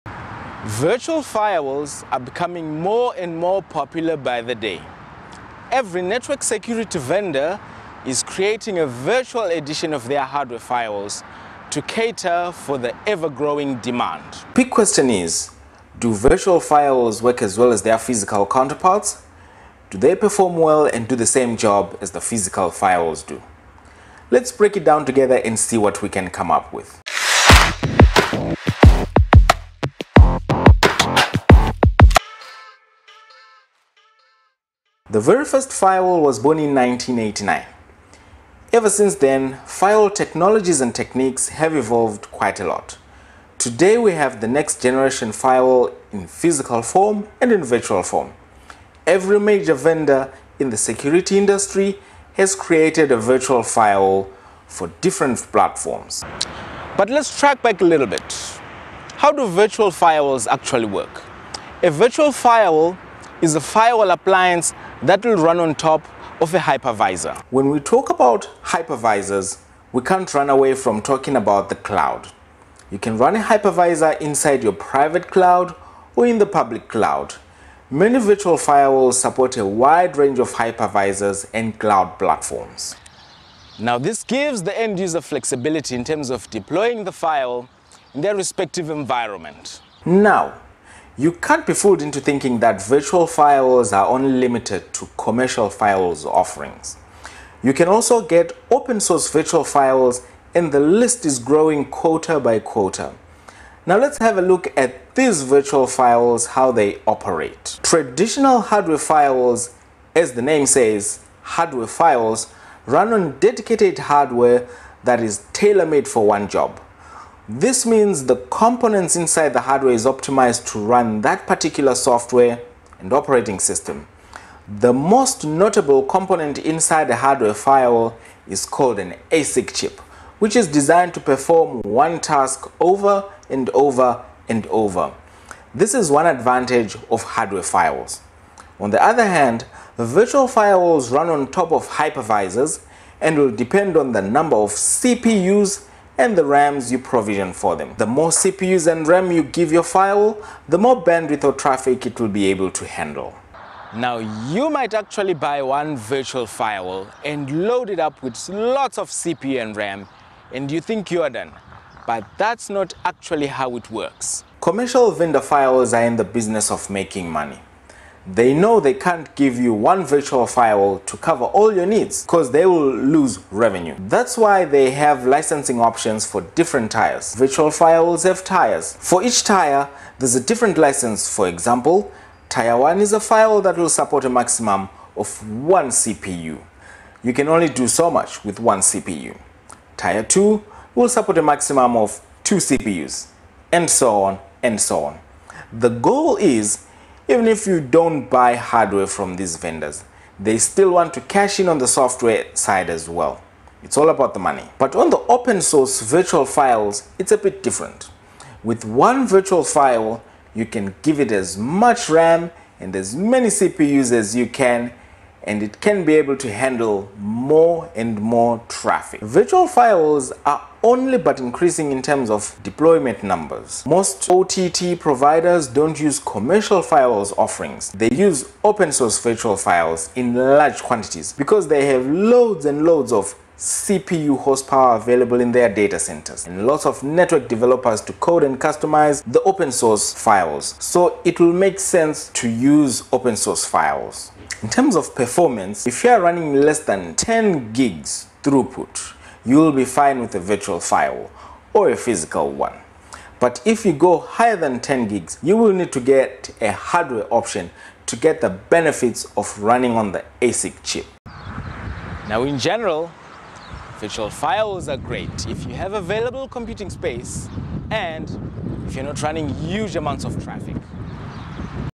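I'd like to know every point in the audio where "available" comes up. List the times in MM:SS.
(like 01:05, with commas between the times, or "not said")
03:54, 04:25.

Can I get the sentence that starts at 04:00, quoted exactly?
So it will make sense to use open source firewalls.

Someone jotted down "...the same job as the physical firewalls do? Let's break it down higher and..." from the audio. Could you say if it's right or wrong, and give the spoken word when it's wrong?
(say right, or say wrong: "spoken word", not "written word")
wrong: "together", not "higher".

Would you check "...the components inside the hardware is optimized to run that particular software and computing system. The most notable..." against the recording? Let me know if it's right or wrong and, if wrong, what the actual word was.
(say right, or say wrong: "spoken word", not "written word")
wrong: "operating", not "computing".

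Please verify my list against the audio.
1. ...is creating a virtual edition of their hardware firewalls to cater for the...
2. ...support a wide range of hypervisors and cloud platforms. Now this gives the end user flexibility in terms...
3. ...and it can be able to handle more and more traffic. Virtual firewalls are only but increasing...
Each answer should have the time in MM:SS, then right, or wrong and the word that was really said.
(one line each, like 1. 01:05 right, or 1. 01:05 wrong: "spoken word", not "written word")
1. 00:08 right
2. 01:19 right
3. 03:35 right.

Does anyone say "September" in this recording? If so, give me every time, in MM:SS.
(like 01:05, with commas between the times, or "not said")
not said.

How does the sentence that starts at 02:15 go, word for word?
This is one advantage of hardware firewalls.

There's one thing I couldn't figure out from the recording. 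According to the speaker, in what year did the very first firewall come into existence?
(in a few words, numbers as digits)
1989.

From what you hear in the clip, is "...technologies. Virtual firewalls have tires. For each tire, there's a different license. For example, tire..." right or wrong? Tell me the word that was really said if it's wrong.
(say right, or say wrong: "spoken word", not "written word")
wrong: "tires", not "technologies".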